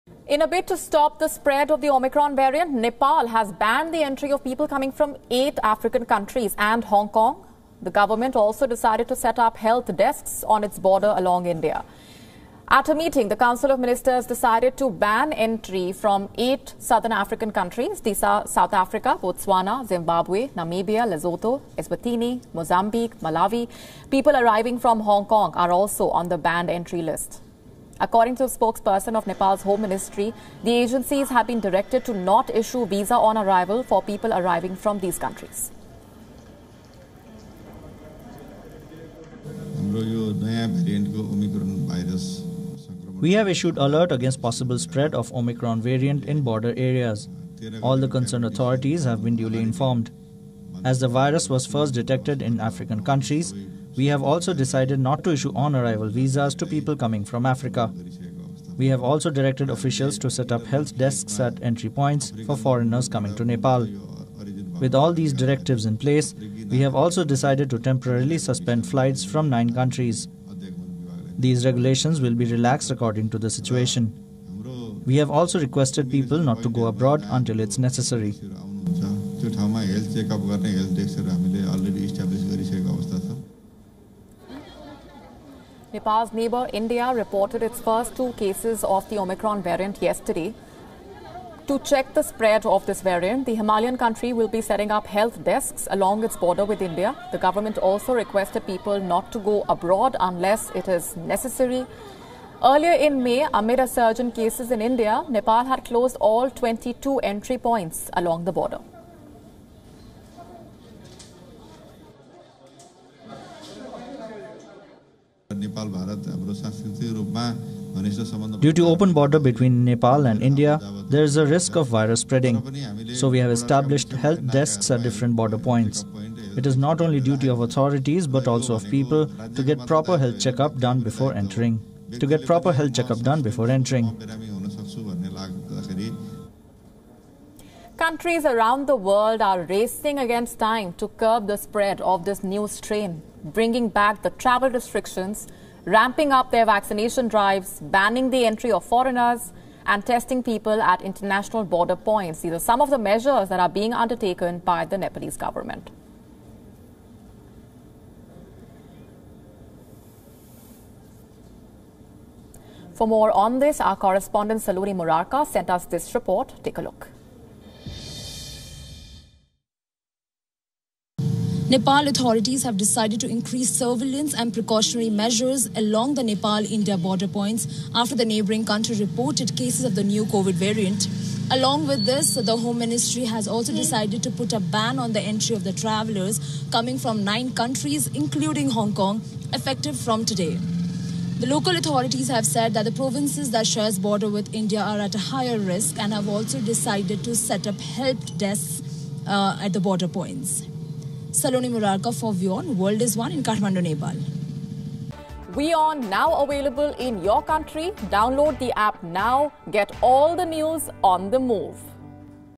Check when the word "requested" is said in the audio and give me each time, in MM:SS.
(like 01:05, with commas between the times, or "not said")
01:15, 01:38.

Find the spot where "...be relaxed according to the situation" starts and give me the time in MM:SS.
01:12.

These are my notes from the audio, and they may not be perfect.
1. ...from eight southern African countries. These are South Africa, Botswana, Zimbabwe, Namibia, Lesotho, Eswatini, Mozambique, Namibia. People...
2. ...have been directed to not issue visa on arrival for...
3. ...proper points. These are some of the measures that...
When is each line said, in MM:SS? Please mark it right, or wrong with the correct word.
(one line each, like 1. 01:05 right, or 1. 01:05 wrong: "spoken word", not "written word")
1. 00:15 wrong: "Malawi", not "Namibia"
2. 00:31 right
3. 02:31 wrong: "border", not "proper".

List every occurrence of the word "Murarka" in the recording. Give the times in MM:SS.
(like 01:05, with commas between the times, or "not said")
02:44, 03:21.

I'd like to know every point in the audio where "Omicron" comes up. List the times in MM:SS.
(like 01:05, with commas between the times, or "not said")
00:01, 00:45, 01:29.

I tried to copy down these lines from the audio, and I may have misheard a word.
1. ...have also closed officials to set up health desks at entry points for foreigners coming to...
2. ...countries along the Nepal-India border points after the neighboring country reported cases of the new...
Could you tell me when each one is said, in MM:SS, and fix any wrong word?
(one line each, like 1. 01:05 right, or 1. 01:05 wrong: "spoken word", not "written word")
1. 00:58 wrong: "directed", not "closed"
2. 02:55 wrong: "measures", not "countries".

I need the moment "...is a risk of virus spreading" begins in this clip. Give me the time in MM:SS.
02:01.